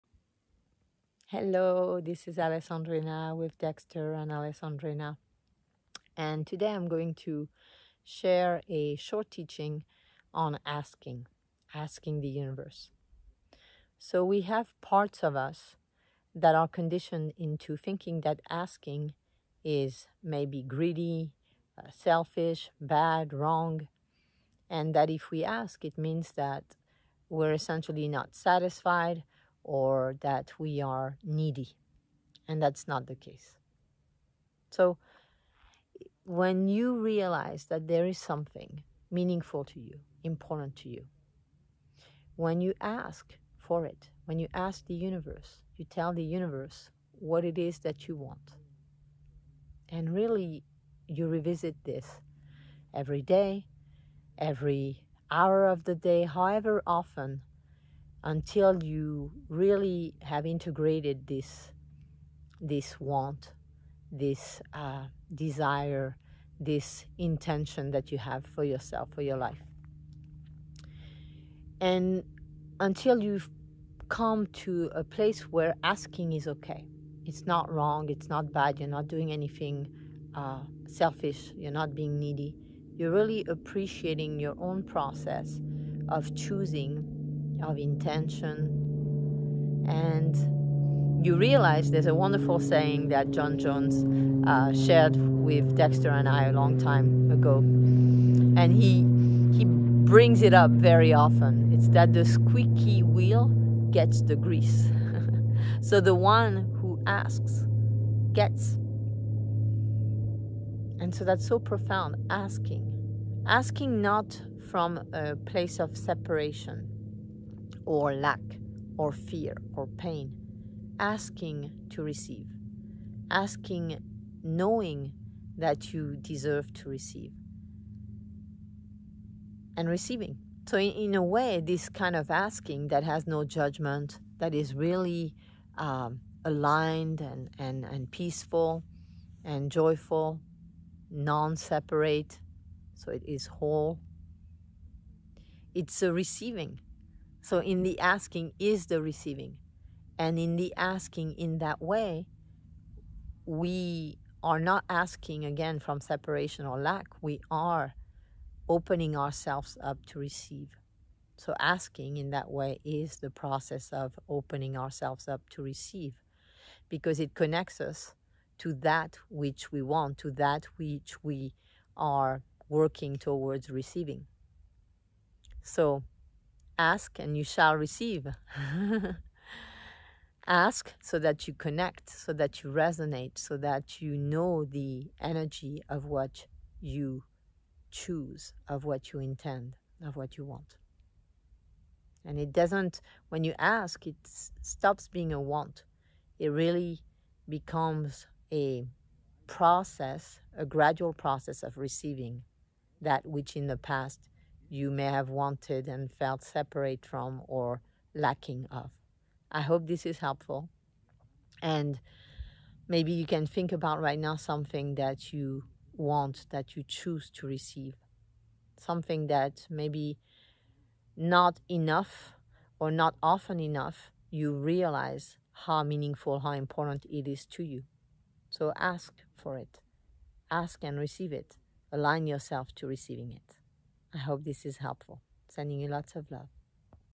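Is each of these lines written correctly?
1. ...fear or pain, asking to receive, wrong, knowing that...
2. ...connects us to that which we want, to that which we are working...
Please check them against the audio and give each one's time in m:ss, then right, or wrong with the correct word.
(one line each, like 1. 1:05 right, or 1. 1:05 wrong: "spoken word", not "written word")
1. 1:59 wrong: "asking", not "wrong"
2. 2:47 right.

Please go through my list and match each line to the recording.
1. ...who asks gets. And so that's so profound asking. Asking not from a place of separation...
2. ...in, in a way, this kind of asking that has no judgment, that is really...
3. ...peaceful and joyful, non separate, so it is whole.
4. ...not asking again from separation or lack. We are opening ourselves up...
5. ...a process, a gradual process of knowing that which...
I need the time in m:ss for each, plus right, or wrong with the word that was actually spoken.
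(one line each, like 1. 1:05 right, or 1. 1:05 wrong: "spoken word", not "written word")
1. 1:46 right
2. 2:10 right
3. 2:18 right
4. 2:34 right
5. 3:18 wrong: "receiving", not "knowing".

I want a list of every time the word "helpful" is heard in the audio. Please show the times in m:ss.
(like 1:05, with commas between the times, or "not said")
3:30, 3:54.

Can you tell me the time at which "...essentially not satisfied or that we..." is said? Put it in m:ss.
0:27.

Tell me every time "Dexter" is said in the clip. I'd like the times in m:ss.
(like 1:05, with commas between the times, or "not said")
0:03, 1:35.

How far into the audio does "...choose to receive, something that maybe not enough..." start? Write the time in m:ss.
3:36.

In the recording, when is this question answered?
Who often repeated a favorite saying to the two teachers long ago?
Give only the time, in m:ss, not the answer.
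1:33.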